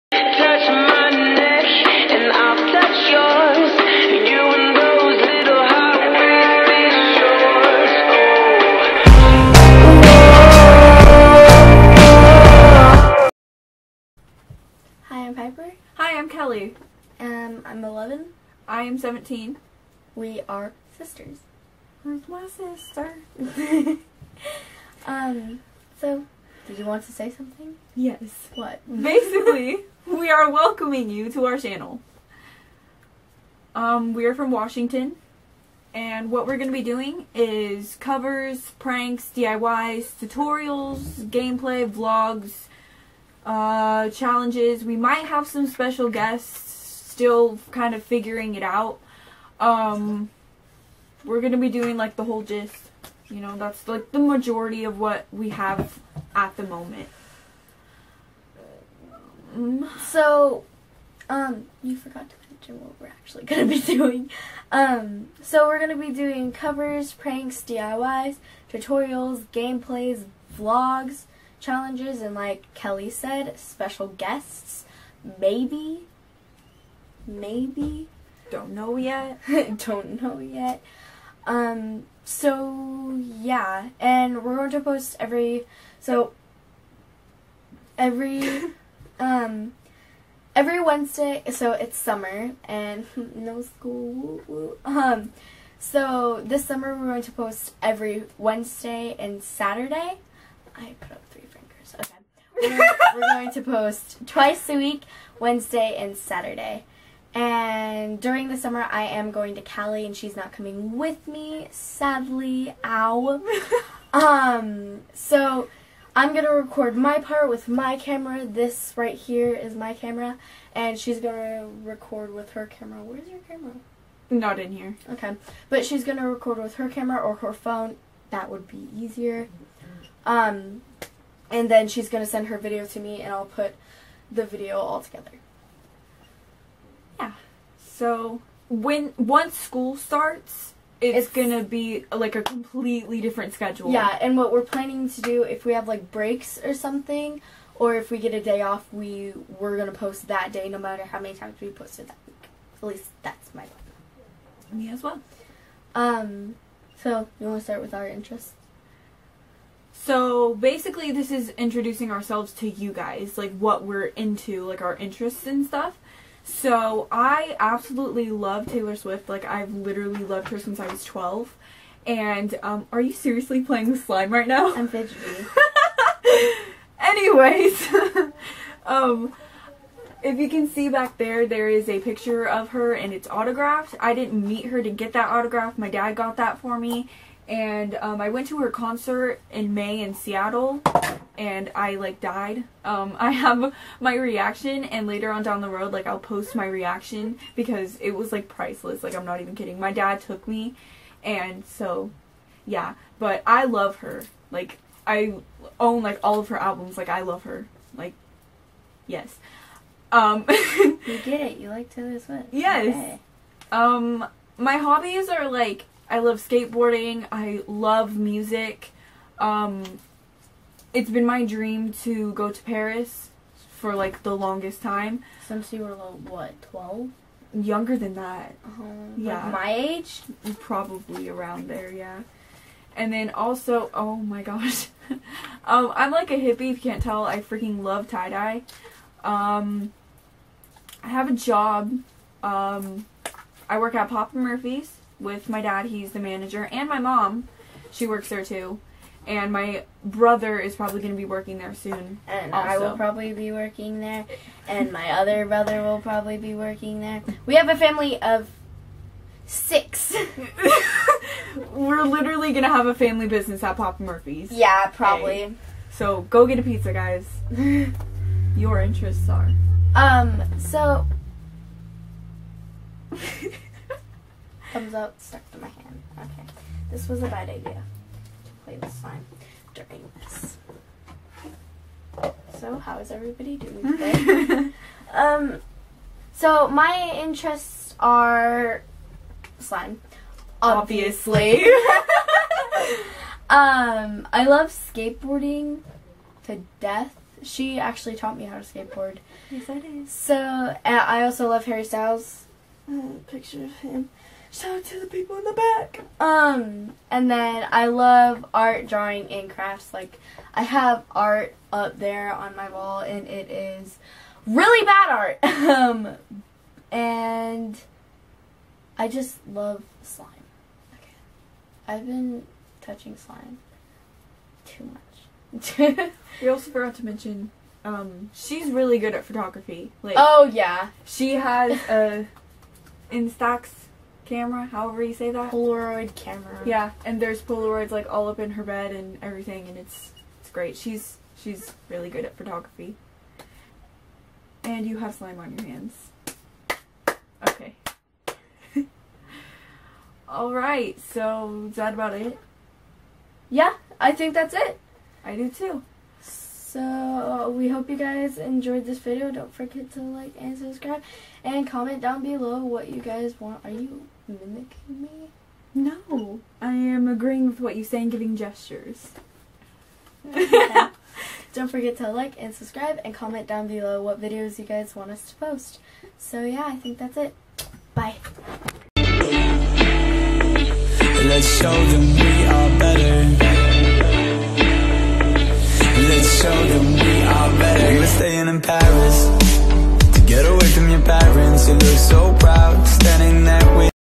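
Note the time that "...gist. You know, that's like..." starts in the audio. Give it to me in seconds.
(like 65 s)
52 s.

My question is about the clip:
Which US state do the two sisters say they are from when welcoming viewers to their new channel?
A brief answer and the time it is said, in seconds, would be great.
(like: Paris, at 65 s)
Washington, at 34 s.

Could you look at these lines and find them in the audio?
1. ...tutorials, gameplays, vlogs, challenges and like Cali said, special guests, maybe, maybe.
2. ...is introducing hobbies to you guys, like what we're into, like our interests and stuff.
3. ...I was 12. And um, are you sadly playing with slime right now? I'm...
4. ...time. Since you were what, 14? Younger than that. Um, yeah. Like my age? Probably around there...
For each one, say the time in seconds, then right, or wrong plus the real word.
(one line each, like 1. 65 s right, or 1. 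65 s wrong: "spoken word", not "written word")
1. 68 s wrong: "Kelly", not "Cali"
2. 161 s wrong: "ourselves", not "hobbies"
3. 170 s wrong: "seriously", not "sadly"
4. 224 s wrong: "12", not "14".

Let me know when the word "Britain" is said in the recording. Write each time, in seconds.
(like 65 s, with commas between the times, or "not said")
not said.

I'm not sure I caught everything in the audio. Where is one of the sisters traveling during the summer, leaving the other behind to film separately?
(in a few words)
Cali.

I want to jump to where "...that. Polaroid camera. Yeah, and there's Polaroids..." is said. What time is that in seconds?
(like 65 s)
335 s.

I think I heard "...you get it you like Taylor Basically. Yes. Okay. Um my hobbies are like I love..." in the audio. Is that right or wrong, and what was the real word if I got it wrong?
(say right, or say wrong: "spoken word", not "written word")
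wrong: "Swift", not "Basically".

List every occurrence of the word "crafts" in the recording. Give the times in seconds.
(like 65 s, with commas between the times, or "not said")
309 s.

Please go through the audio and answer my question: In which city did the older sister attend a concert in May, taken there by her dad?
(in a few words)
Seattle.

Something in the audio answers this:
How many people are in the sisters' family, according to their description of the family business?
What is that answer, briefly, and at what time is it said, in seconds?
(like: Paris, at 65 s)
6, at 259 s.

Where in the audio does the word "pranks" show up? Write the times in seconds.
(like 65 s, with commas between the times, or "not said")
38 s, 67 s.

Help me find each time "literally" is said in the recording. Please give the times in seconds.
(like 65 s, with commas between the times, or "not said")
169 s, 262 s.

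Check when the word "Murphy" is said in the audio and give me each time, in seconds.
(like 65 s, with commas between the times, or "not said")
244 s, 264 s.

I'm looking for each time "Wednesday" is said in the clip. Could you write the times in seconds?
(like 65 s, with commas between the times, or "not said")
90 s, 98 s, 105 s.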